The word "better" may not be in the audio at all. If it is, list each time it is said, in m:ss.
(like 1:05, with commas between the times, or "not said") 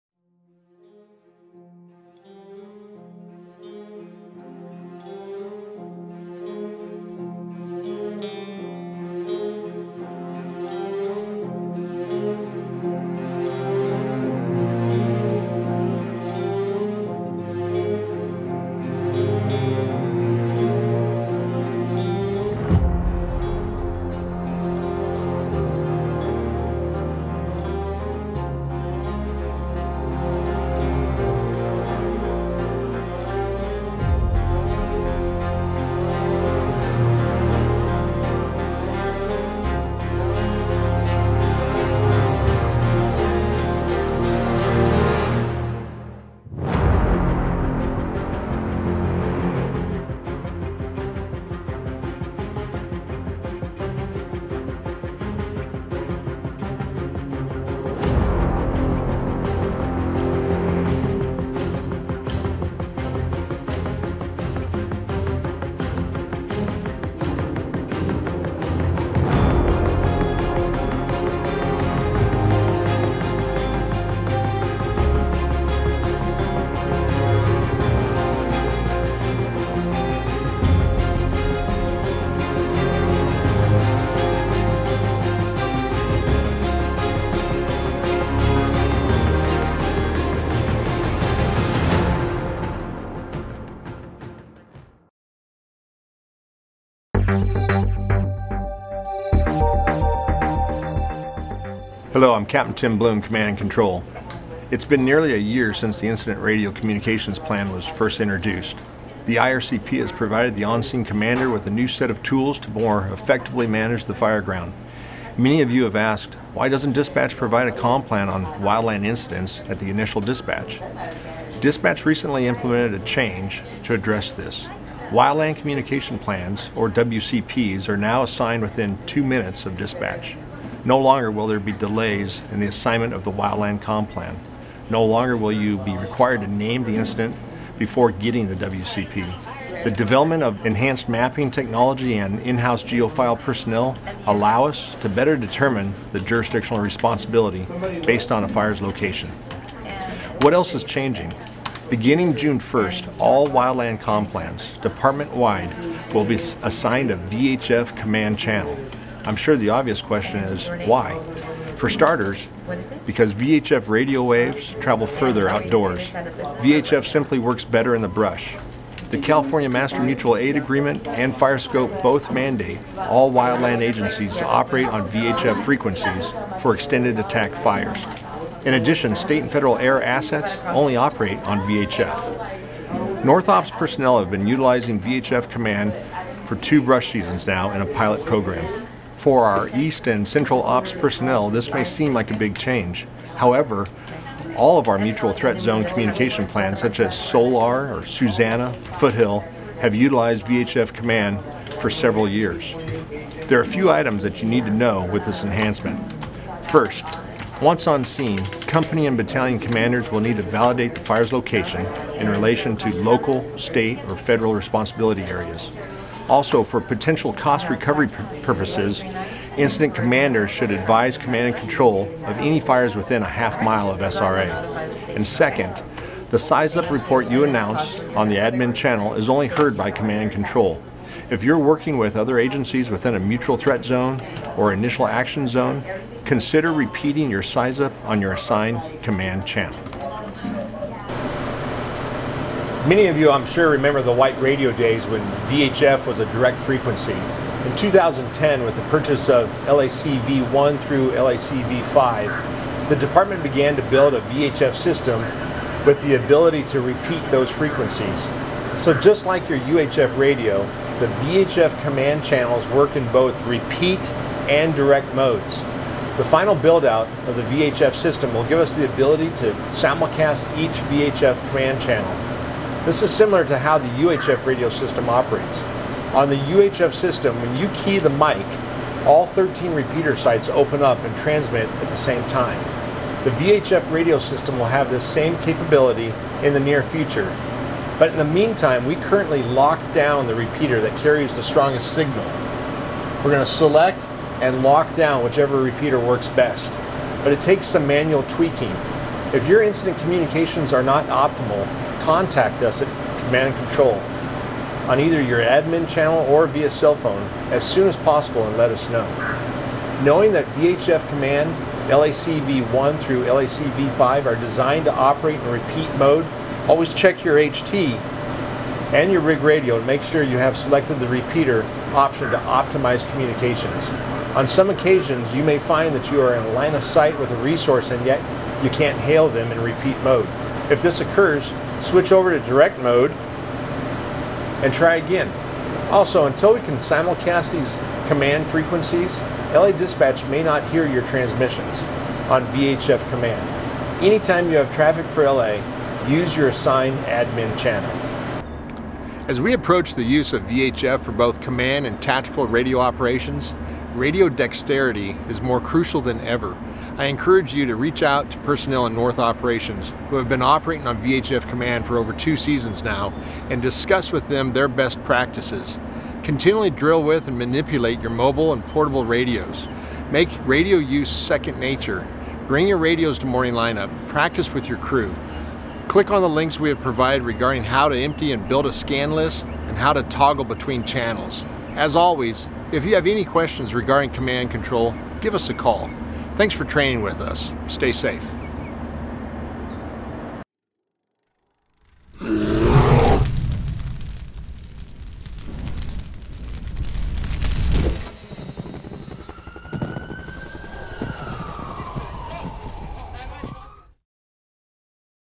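2:25, 2:47.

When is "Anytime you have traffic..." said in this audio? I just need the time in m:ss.
5:44.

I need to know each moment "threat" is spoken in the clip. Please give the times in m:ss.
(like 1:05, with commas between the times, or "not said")
3:15, 3:53.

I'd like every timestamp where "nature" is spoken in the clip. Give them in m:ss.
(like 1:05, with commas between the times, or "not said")
6:11.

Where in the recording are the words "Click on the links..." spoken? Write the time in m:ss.
6:15.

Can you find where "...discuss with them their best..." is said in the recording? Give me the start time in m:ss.
6:03.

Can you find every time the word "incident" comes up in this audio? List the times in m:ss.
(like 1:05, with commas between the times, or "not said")
1:46, 1:59, 2:16, 3:39, 4:59.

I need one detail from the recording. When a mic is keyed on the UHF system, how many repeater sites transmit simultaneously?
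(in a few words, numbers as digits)
13.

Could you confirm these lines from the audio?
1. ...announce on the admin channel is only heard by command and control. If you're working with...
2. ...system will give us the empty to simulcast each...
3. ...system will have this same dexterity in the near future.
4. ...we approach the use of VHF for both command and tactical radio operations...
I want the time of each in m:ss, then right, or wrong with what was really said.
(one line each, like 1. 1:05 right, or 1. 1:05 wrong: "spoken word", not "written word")
1. 3:47 right
2. 4:27 wrong: "ability", not "empty"
3. 4:44 wrong: "capability", not "dexterity"
4. 5:49 right.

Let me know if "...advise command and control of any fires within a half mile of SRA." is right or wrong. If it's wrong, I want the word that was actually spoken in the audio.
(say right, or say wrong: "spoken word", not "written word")
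right.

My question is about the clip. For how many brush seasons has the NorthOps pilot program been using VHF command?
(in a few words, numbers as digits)
2.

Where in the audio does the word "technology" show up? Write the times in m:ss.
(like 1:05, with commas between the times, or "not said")
2:21.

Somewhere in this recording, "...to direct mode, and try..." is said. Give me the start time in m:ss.
5:32.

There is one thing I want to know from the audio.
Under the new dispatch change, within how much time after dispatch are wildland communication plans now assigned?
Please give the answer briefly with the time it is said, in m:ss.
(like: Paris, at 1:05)
2 minutes, at 2:09.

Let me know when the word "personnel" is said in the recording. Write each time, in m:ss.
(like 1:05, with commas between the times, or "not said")
2:23, 3:03, 3:10, 5:58.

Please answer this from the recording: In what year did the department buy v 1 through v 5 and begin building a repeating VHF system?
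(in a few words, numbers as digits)
2010.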